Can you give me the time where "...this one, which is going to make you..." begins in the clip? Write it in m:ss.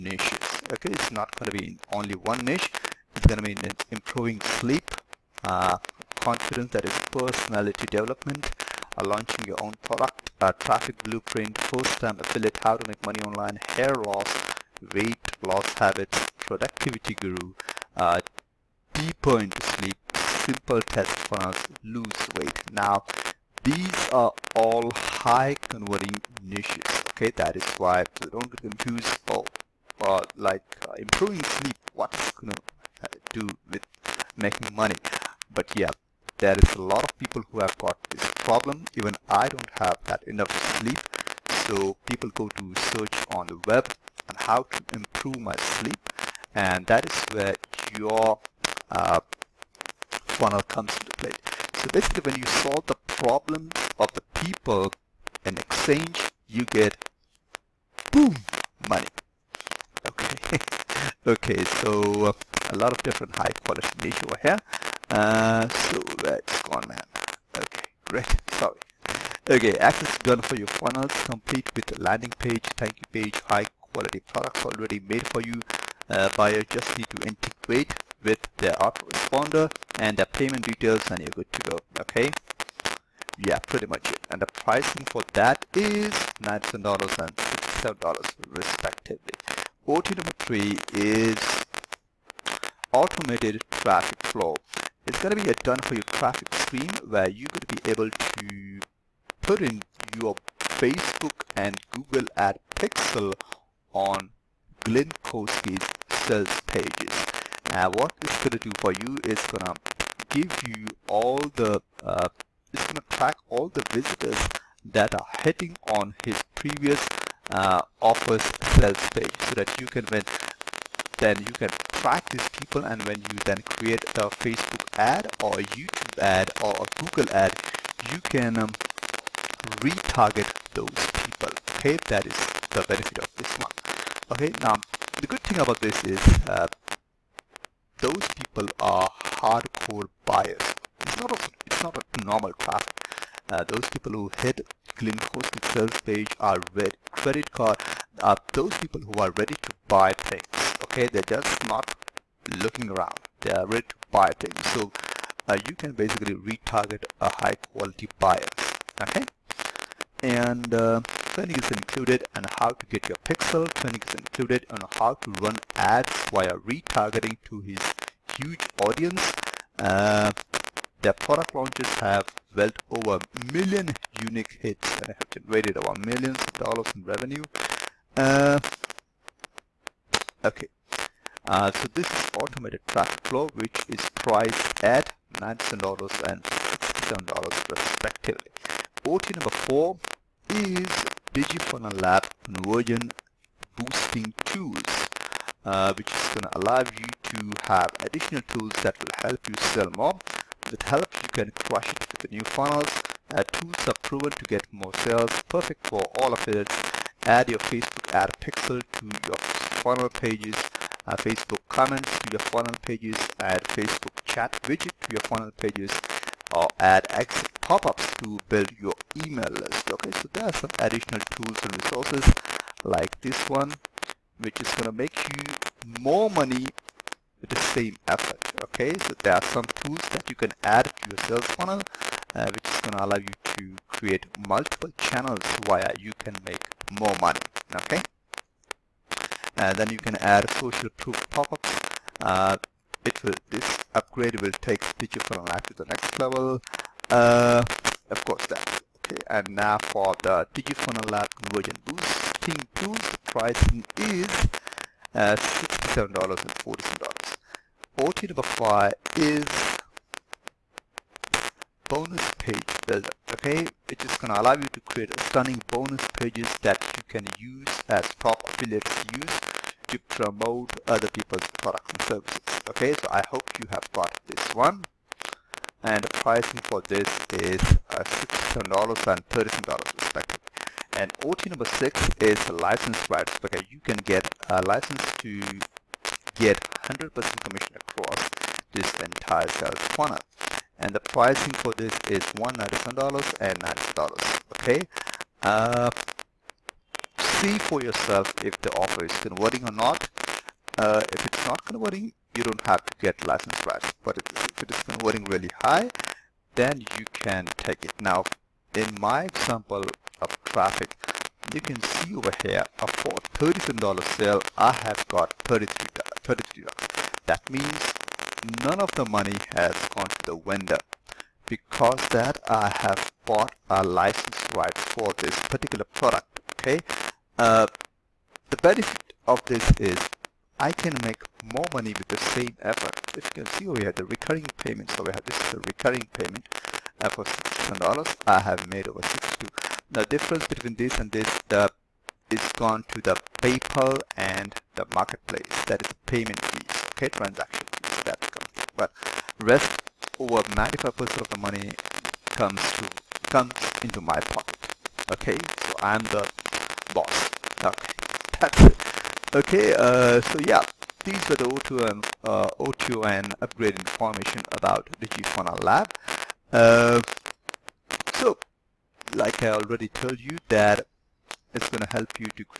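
3:43.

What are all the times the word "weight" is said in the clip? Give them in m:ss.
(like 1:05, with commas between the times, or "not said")
0:14, 0:22.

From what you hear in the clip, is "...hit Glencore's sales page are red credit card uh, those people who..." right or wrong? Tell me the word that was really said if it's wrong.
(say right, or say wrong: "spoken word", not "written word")
right.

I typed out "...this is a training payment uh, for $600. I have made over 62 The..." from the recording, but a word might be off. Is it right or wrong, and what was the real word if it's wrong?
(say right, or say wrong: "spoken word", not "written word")
wrong: "recurring", not "training".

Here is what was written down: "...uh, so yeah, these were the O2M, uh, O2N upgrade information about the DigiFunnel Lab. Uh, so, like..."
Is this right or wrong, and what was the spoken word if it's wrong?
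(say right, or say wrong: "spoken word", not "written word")
right.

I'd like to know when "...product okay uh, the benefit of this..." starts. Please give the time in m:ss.
5:25.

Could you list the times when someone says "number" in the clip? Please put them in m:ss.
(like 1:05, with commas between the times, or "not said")
1:30, 3:09, 4:18, 4:41.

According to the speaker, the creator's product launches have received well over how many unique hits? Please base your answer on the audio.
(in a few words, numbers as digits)
A million.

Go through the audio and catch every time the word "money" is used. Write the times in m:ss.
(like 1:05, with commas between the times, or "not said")
0:13, 0:34, 0:58, 3:46, 3:57, 5:19, 5:31, 5:51.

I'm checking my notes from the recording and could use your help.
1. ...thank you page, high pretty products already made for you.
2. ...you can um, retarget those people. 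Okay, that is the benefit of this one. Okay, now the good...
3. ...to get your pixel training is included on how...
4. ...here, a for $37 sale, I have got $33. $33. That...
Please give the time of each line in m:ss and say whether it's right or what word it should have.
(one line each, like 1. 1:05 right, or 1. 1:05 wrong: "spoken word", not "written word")
1. 1:12 wrong: "quality", not "pretty"
2. 2:08 right
3. 2:42 right
4. 5:12 right.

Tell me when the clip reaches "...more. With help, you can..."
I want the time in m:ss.
3:19.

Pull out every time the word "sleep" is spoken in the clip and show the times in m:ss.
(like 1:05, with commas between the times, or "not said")
0:04, 0:19, 0:31, 0:40, 0:45.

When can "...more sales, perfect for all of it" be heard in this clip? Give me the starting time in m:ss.
3:24.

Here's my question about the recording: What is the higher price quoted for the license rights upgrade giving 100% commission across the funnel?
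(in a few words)
$197.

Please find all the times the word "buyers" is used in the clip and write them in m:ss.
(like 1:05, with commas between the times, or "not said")
1:16, 2:20, 2:38.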